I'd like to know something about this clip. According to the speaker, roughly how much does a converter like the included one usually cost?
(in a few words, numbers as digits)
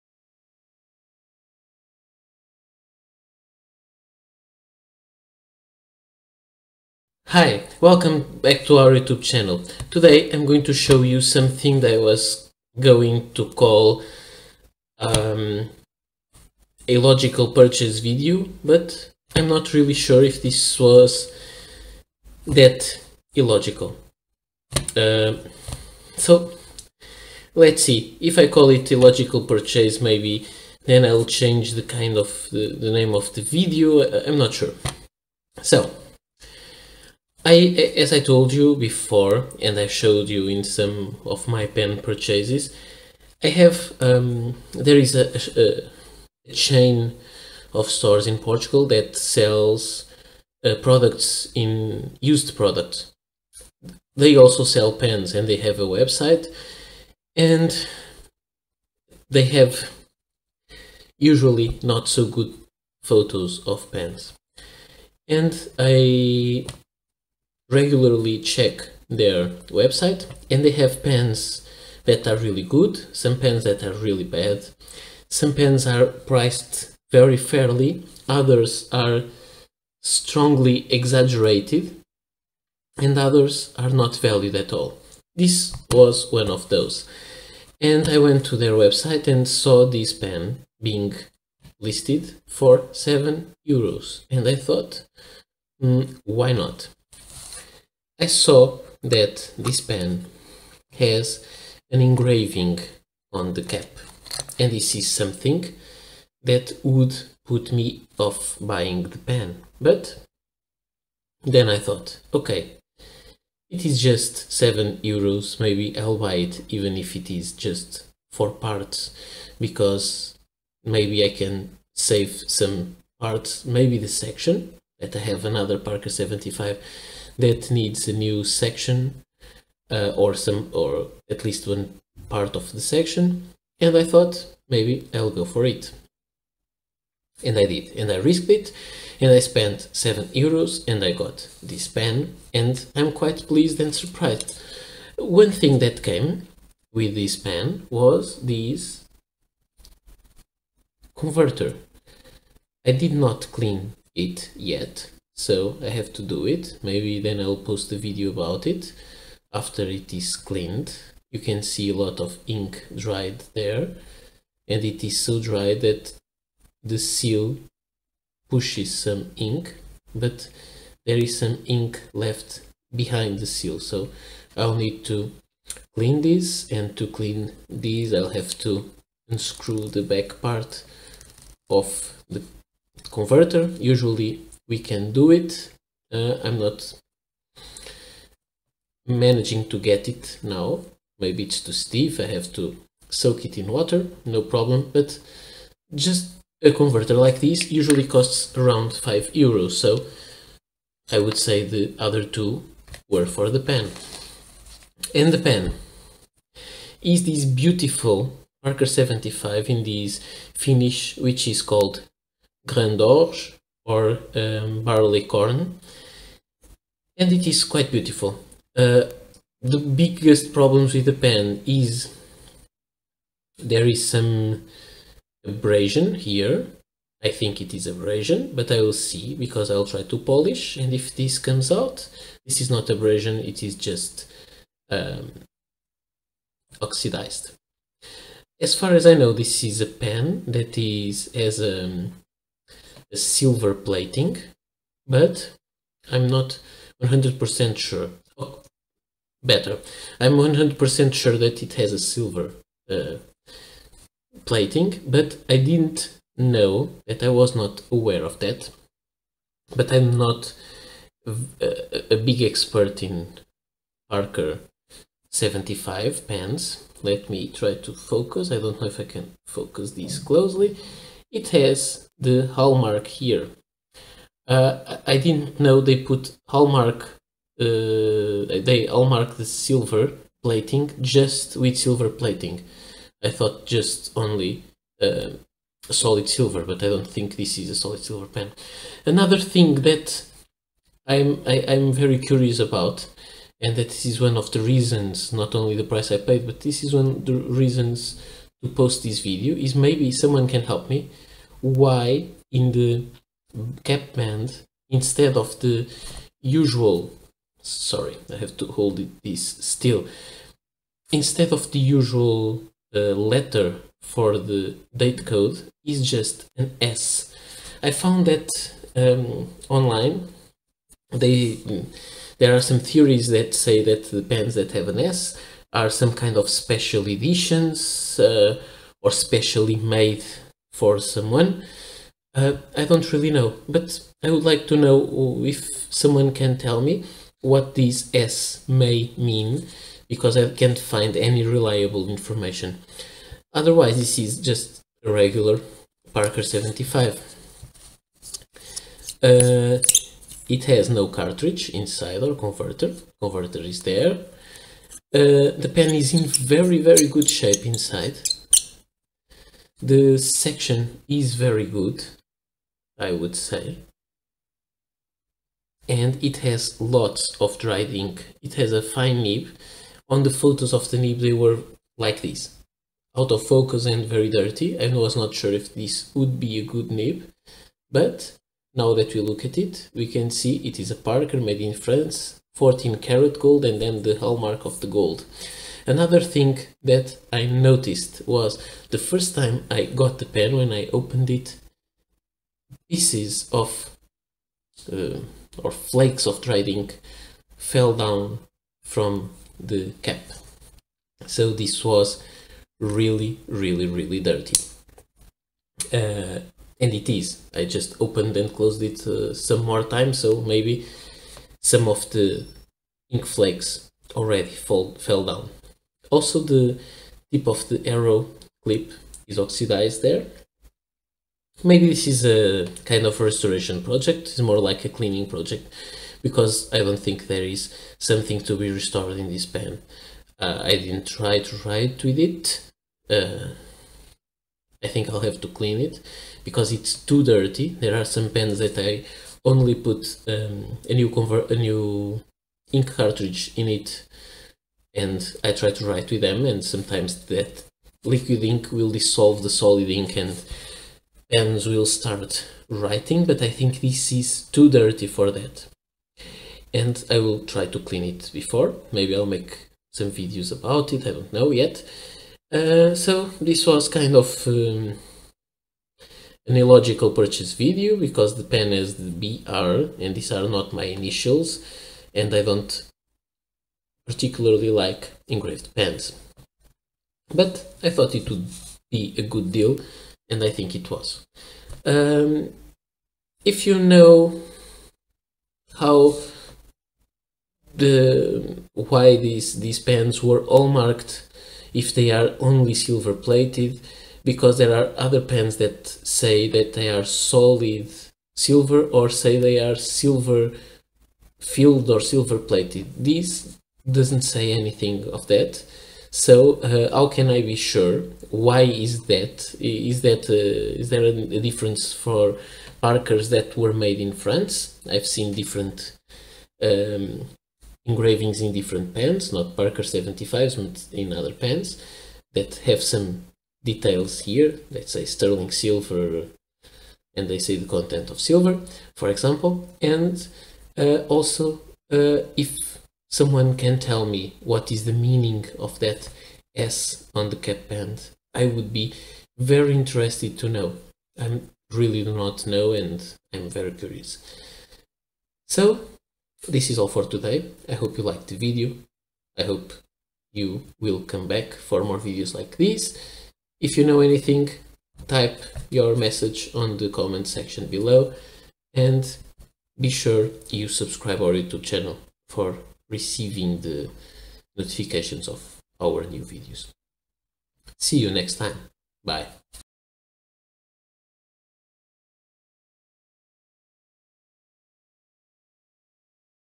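5 euros.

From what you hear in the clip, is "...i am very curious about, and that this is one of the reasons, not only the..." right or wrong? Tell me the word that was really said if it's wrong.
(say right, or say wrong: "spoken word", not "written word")
right.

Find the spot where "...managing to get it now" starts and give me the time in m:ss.
3:09.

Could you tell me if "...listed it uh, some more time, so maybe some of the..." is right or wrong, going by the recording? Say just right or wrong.
wrong.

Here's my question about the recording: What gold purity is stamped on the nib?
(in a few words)
14 karat.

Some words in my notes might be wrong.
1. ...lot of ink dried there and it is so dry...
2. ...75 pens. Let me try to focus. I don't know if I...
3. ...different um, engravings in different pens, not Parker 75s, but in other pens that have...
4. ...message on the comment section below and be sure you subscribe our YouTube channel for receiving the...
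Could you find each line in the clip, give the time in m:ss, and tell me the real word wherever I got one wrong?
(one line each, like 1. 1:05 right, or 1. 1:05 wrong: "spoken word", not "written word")
1. 2:42 right
2. 4:25 right
3. 8:35 right
4. 9:15 right.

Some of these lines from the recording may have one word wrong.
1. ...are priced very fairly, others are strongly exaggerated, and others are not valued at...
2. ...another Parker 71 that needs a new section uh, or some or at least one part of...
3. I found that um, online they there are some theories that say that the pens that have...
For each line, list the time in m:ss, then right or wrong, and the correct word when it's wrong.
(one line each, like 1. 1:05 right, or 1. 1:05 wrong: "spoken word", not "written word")
1. 1:15 right
2. 2:05 wrong: "75", not "71"
3. 5:17 right.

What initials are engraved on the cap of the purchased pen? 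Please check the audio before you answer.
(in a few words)
BR.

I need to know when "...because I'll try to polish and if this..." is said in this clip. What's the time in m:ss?
3:49.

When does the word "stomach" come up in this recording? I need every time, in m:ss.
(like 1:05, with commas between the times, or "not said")
not said.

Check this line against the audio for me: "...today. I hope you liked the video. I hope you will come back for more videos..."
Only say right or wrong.
right.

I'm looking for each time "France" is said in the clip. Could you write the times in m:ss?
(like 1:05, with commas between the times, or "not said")
6:21, 8:34.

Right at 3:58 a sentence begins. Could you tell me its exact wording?
As far as I know, this is a pen that is as a um, silver plating, but I'm not 100% sure.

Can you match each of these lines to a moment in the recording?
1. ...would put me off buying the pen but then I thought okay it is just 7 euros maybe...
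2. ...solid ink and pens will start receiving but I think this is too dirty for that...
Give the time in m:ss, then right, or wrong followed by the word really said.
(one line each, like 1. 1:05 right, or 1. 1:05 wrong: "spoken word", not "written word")
1. 1:46 right
2. 7:29 wrong: "writing", not "receiving".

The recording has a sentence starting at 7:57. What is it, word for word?
But I thought it would be a good deal and I think it was.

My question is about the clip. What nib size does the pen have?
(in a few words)
Fine.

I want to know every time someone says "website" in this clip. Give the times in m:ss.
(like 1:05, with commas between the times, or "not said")
0:55, 1:09, 1:28.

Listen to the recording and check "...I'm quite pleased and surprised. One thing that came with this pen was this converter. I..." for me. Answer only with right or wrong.
right.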